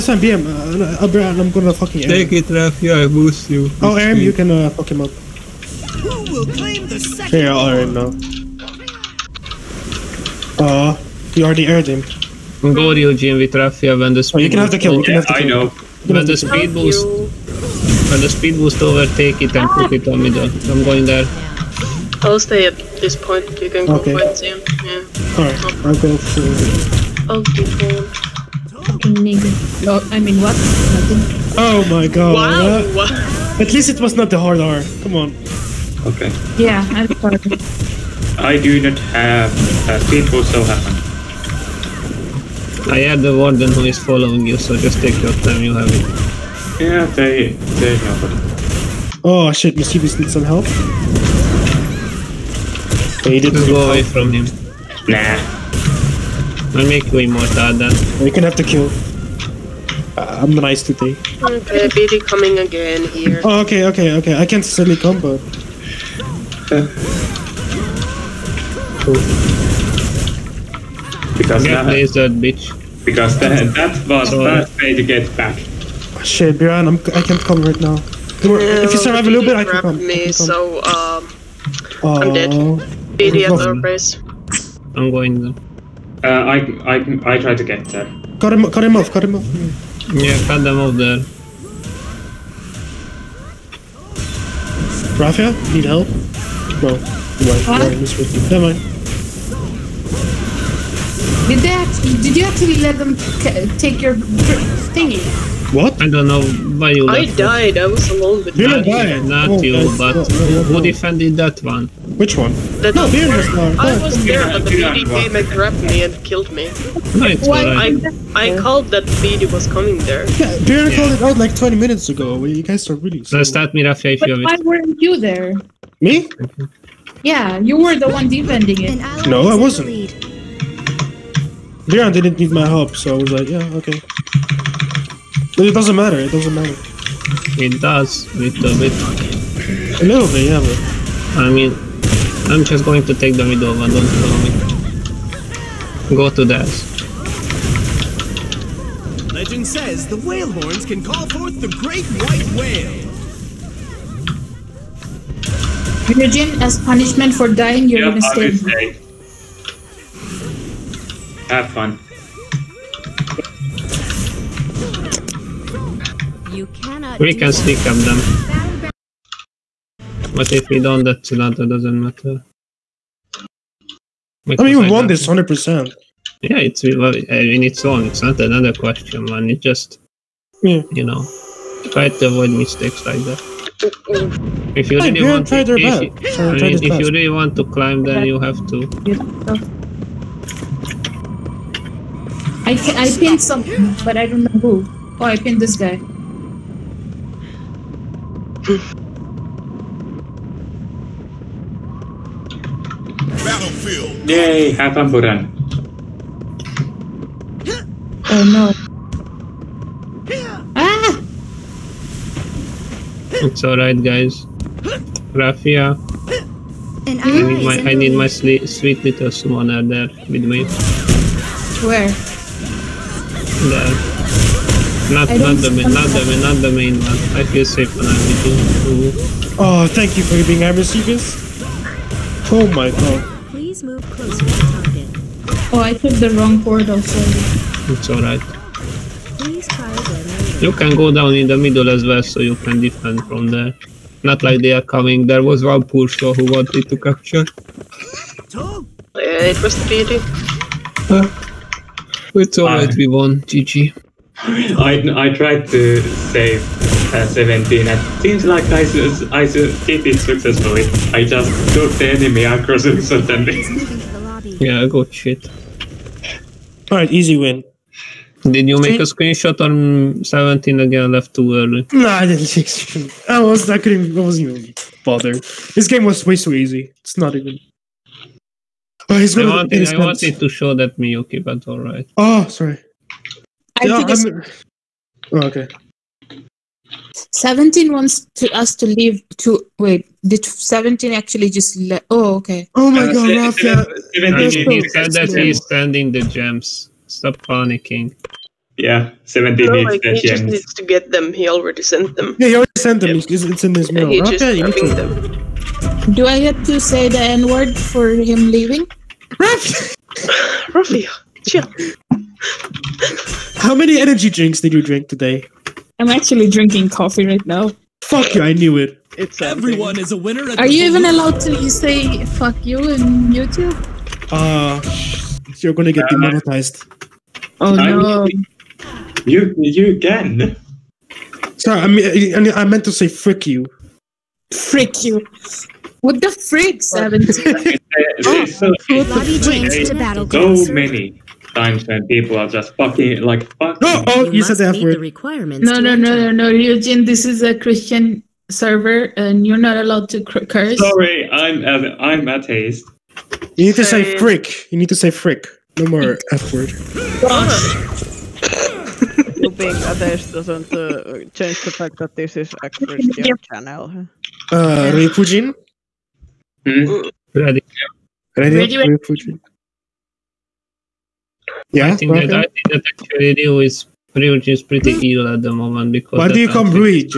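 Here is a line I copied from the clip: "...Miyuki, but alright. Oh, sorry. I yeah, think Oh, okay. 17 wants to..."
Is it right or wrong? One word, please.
right.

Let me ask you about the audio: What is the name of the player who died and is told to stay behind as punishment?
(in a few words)
Imogen.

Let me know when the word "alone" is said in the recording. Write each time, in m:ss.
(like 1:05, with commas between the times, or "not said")
1:48.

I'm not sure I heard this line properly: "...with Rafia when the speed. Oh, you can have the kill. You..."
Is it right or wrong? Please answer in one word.
right.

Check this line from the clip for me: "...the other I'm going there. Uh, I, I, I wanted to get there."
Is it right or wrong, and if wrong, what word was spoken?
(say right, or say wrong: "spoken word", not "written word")
wrong: "tried", not "wanted".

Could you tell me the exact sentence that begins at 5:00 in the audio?
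He just needs to get them.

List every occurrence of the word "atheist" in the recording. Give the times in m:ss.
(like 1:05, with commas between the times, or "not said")
5:52, 5:59.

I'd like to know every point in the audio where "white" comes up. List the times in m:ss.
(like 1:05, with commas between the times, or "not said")
2:32.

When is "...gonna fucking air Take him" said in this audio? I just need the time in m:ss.
0:01.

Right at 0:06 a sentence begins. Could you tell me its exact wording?
Who will claim the second Yeah, i now.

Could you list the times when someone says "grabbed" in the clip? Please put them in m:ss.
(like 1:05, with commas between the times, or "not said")
1:55.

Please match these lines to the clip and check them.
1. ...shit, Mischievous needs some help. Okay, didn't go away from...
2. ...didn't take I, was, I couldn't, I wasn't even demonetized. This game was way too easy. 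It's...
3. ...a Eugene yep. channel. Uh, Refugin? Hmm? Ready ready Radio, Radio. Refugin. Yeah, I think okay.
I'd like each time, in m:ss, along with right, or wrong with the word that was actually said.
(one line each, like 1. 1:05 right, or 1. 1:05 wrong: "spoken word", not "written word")
1. 0:49 right
2. 4:32 wrong: "bothered", not "demonetized"
3. 6:02 wrong: "Christian", not "Eugene".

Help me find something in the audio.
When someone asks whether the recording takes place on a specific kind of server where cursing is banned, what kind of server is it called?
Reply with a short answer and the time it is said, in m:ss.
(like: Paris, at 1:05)
Christian server, at 5:47.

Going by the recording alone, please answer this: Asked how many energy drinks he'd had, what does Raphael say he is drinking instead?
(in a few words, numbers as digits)
coffee.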